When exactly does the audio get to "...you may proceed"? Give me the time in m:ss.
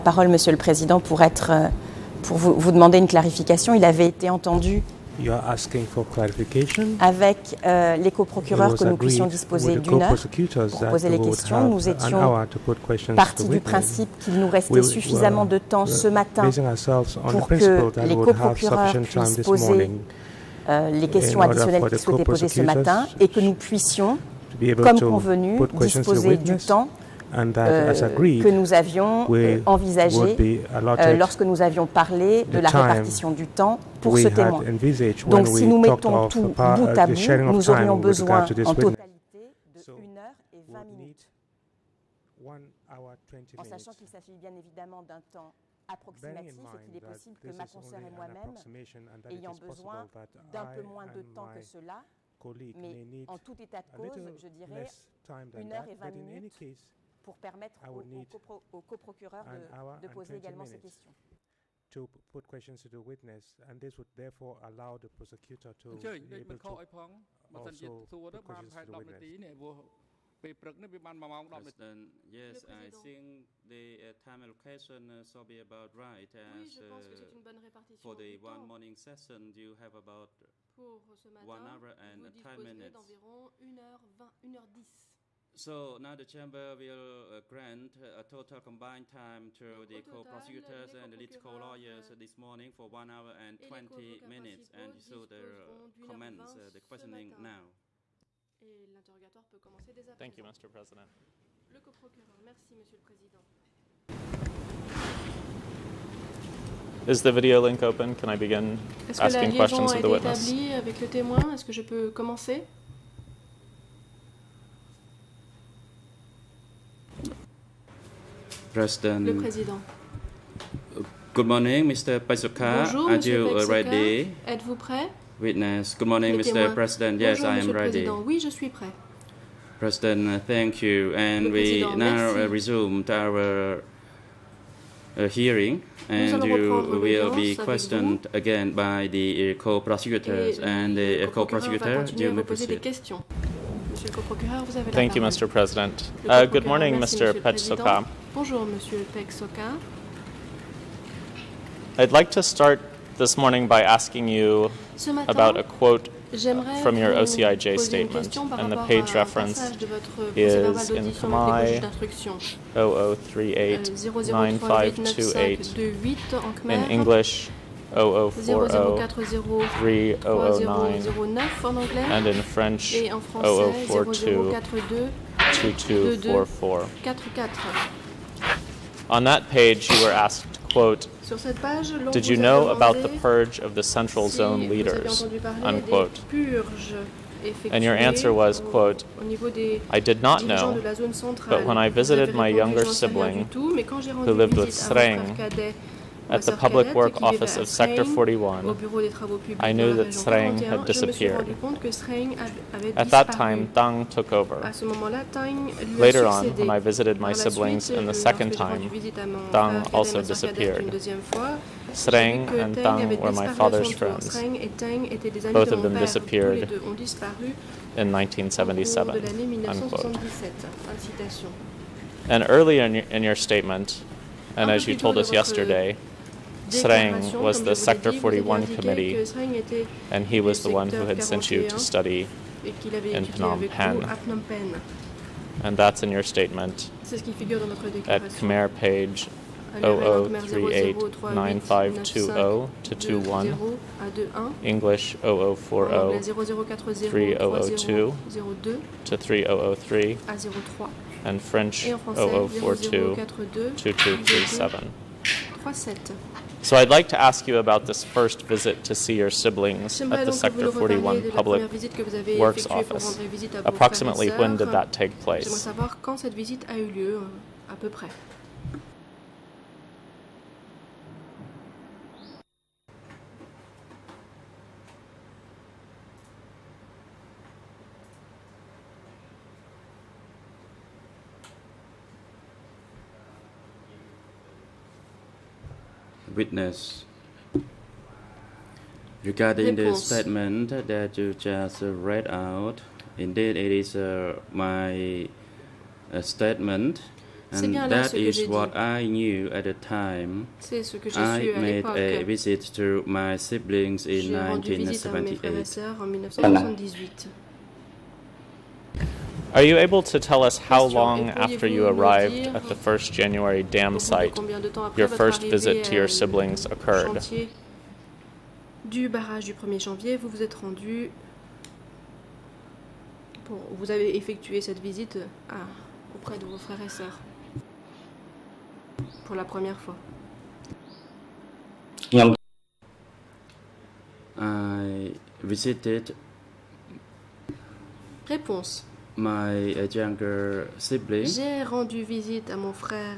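2:22.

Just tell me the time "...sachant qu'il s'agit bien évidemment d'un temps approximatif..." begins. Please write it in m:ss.
0:43.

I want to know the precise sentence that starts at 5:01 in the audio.
I made a visit to my siblings in 1978.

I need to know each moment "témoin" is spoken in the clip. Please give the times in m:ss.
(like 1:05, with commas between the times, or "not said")
0:34, 1:51, 2:06.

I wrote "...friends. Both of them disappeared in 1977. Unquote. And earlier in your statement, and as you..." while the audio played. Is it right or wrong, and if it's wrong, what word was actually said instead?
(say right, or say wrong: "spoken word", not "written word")
right.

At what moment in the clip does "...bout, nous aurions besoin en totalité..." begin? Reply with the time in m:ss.
0:37.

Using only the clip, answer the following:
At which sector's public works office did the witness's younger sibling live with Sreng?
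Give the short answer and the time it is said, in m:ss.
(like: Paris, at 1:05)
Sector 41, at 3:16.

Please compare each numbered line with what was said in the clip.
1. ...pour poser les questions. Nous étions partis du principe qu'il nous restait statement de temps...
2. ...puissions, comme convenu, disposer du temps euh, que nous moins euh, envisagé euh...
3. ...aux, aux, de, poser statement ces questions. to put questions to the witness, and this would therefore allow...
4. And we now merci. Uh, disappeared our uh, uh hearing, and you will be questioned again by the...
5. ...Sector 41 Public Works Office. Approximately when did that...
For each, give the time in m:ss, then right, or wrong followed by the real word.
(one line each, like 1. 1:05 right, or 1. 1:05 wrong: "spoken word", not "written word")
1. 0:10 wrong: "suffisamment", not "statement"
2. 0:23 wrong: "avions", not "moins"
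3. 0:57 wrong: "également", not "statement"
4. 2:11 wrong: "resumed", not "disappeared"
5. 4:20 right.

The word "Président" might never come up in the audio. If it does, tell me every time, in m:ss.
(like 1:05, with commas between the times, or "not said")
0:00, 1:43, 1:59, 2:08.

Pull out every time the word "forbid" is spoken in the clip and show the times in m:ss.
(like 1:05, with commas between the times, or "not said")
not said.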